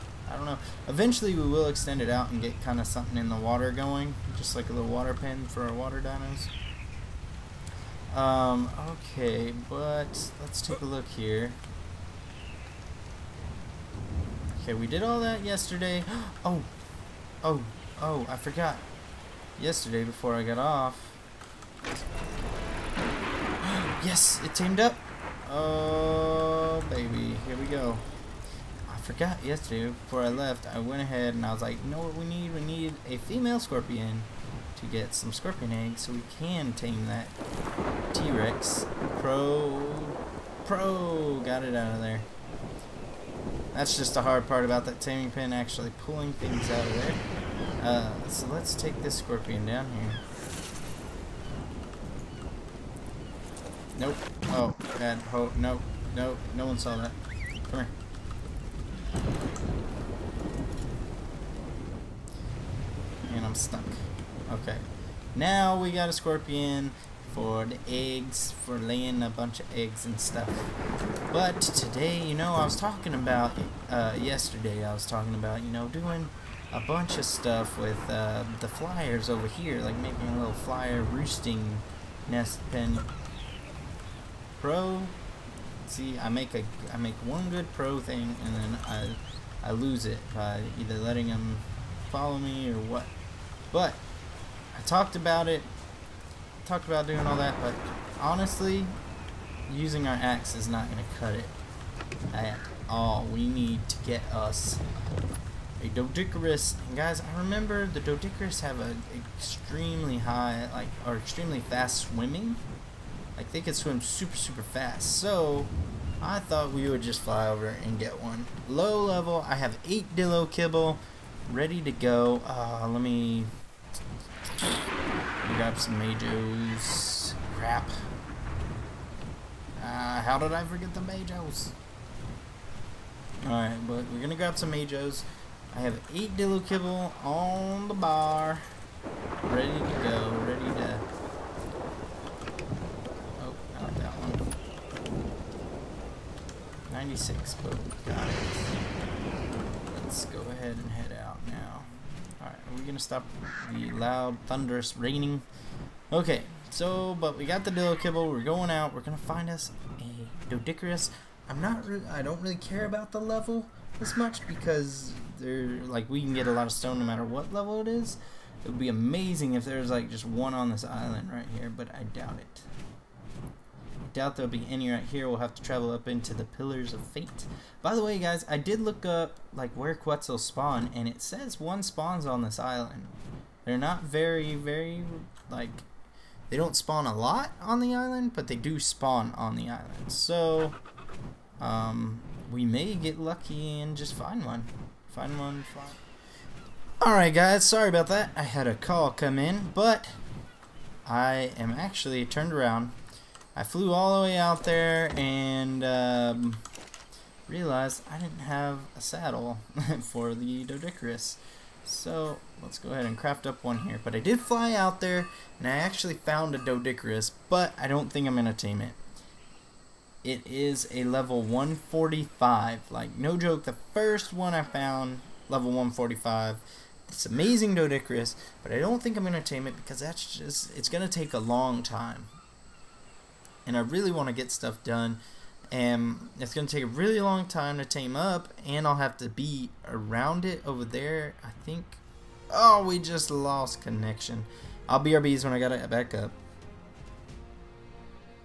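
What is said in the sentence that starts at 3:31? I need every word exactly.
So let's go ahead and craft up one here.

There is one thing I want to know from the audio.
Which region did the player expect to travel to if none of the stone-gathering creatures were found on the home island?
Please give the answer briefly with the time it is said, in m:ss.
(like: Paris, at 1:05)
Pillars of Fate, at 2:56.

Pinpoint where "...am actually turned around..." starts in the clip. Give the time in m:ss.
3:21.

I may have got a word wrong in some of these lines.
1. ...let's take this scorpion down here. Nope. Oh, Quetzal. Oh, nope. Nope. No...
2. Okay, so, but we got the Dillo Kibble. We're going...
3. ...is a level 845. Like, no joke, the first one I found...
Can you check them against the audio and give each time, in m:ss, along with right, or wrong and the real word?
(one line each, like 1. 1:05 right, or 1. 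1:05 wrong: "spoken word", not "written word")
1. 0:48 wrong: "God", not "Quetzal"
2. 2:36 right
3. 3:40 wrong: "145", not "845".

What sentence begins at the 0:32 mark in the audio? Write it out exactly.
We need a female scorpion to get some scorpion eggs so we can tame that T-Rex.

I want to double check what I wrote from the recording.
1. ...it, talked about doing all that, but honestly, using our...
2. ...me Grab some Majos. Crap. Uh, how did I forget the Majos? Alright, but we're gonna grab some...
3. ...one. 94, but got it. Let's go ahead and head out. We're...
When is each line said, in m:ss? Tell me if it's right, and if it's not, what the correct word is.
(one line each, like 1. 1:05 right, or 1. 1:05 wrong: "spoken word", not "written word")
1. 1:35 right
2. 2:02 right
3. 2:24 wrong: "96", not "94".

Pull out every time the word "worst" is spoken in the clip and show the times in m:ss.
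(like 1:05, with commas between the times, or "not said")
not said.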